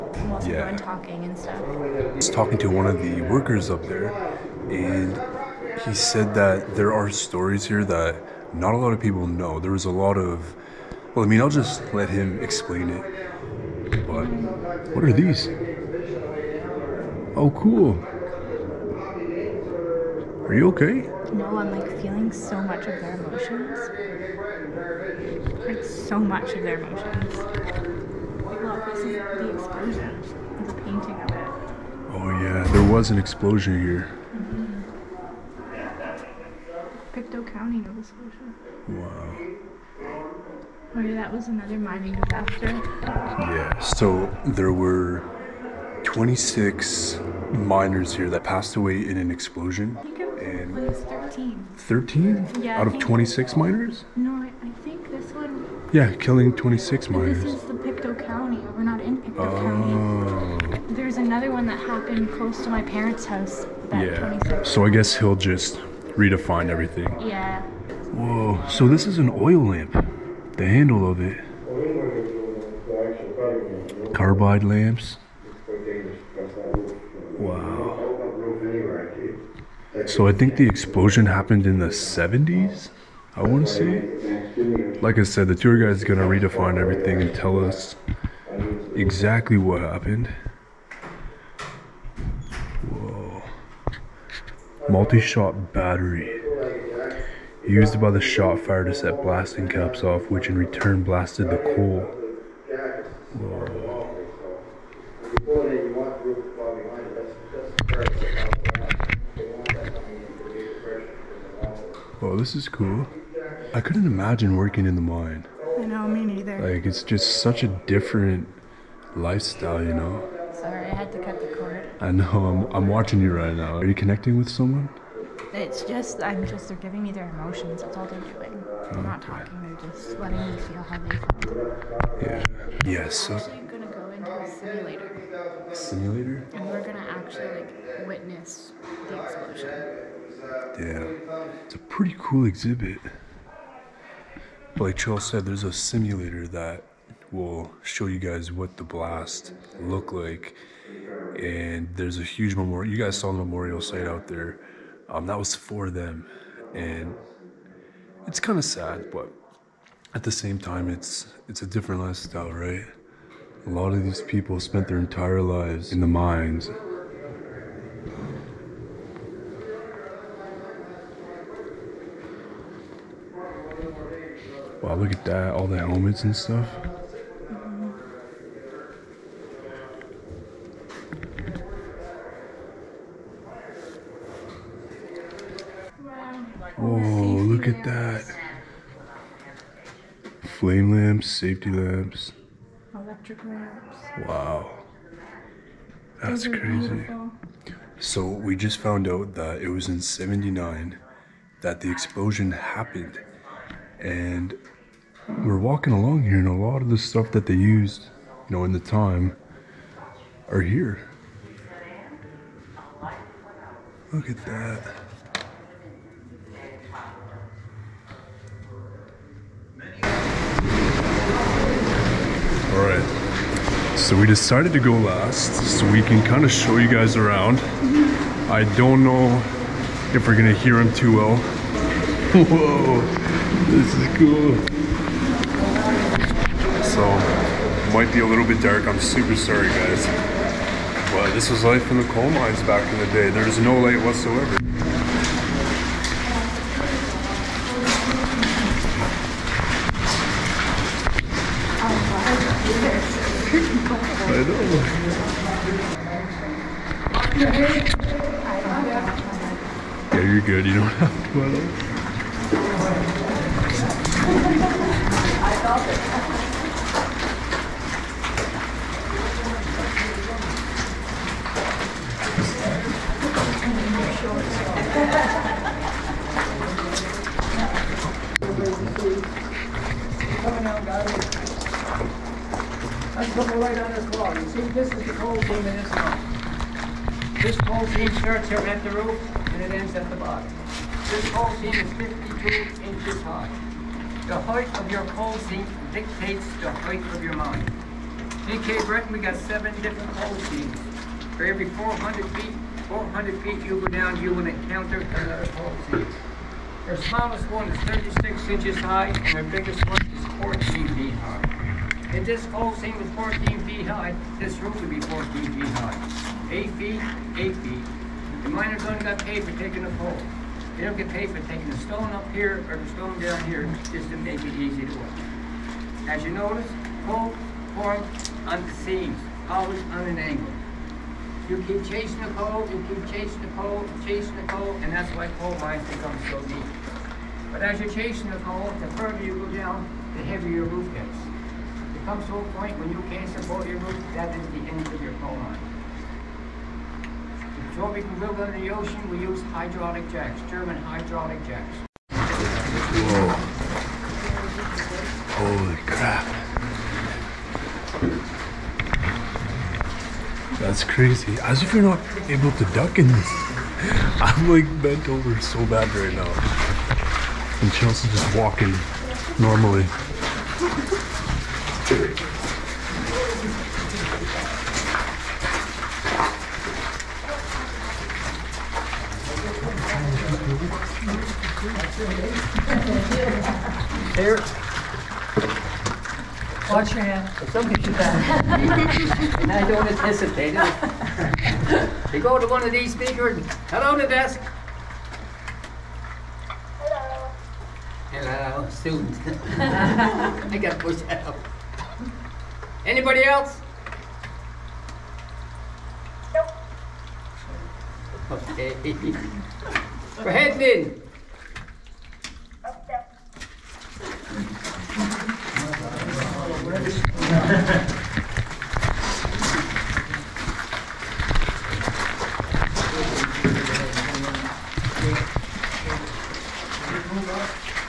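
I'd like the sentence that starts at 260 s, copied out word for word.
good, you don't have to at all.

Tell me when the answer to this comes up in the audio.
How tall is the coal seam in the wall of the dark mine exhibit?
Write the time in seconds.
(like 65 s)
291 s.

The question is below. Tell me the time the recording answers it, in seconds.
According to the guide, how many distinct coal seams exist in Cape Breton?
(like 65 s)
299 s.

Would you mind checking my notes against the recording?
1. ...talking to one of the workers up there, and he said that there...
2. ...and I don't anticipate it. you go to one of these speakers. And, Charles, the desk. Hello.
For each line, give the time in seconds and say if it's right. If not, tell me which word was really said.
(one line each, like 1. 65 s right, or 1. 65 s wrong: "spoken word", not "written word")
1. 2 s right
2. 387 s wrong: "Hello", not "Charles".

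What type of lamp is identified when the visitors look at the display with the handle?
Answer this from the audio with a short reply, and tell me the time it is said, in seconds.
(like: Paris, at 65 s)
Carbide lamps, at 74 s.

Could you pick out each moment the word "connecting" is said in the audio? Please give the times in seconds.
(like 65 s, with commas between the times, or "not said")
123 s.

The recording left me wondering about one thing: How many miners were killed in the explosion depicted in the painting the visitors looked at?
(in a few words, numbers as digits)
26.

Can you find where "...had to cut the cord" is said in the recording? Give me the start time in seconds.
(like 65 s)
120 s.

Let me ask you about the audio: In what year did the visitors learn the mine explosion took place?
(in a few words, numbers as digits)
1979.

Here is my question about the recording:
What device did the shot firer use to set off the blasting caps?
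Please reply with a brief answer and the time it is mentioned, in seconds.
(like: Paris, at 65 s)
Multi-shot battery, at 94 s.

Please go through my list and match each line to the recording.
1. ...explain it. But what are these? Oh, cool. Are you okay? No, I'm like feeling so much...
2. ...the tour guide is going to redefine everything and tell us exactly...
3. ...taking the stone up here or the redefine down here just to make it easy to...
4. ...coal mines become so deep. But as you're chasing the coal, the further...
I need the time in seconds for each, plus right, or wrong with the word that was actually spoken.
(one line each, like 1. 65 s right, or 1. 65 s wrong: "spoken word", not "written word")
1. 12 s right
2. 85 s right
3. 321 s wrong: "stone", not "redefine"
4. 335 s right.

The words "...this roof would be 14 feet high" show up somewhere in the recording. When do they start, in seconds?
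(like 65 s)
314 s.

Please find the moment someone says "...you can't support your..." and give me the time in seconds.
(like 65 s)
342 s.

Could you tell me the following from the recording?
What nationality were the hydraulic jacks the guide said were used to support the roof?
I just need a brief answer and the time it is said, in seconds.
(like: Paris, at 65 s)
German, at 350 s.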